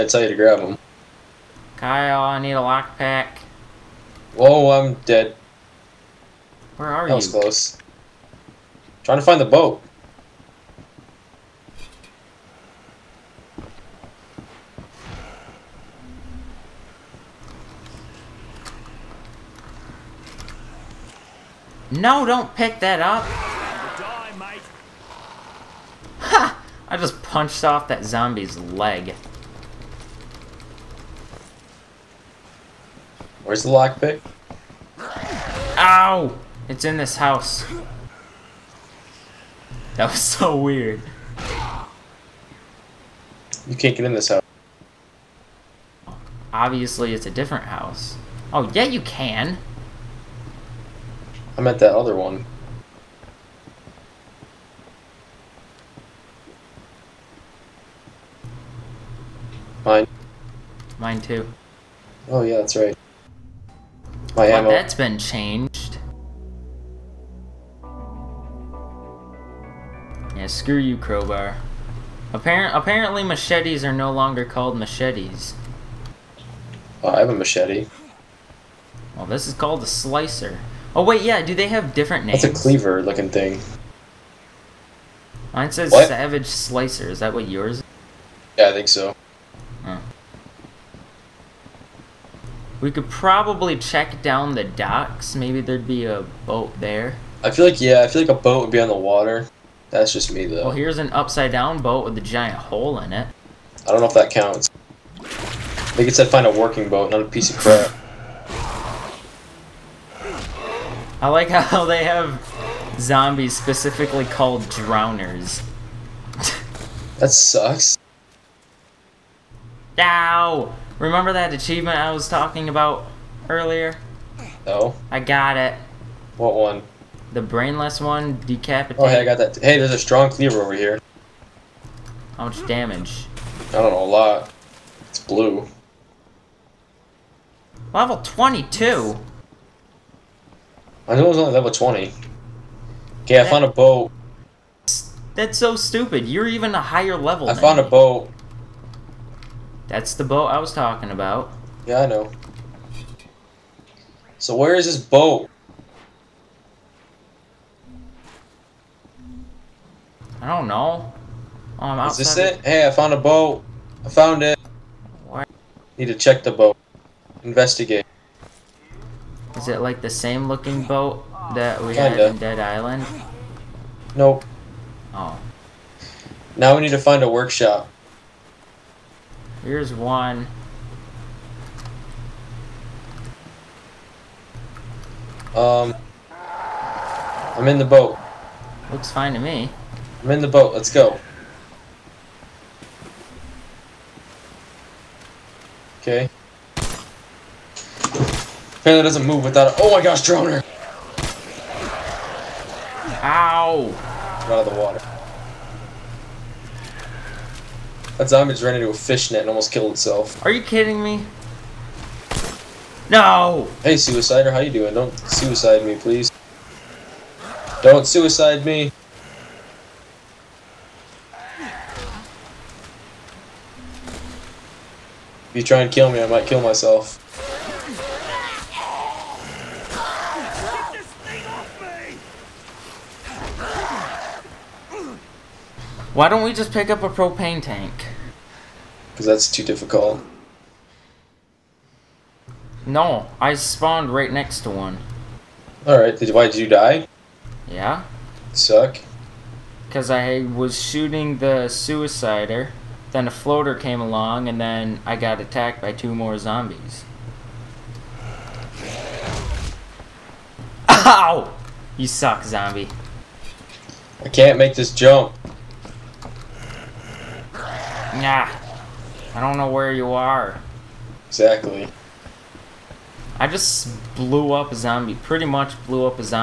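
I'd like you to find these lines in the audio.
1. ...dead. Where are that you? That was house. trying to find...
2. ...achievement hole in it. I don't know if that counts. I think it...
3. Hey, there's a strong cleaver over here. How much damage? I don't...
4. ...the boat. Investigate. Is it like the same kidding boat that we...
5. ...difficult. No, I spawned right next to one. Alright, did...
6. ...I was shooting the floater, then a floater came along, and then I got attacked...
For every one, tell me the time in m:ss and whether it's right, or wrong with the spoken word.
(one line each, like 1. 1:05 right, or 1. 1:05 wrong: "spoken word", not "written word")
1. 0:05 wrong: "close", not "house"
2. 1:42 wrong: "giant", not "achievement"
3. 2:09 right
4. 2:46 wrong: "looking", not "kidding"
5. 3:59 right
6. 4:10 wrong: "suicider", not "floater".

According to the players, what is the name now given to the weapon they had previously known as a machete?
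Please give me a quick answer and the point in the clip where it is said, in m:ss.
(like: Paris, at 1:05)
Savage Slicer, at 1:26.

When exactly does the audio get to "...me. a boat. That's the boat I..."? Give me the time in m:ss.
2:27.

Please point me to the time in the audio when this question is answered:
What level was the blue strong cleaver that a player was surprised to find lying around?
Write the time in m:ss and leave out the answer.
2:17.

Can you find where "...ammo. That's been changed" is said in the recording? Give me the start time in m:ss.
1:04.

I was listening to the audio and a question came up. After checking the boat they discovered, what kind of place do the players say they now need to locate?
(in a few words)
A workshop.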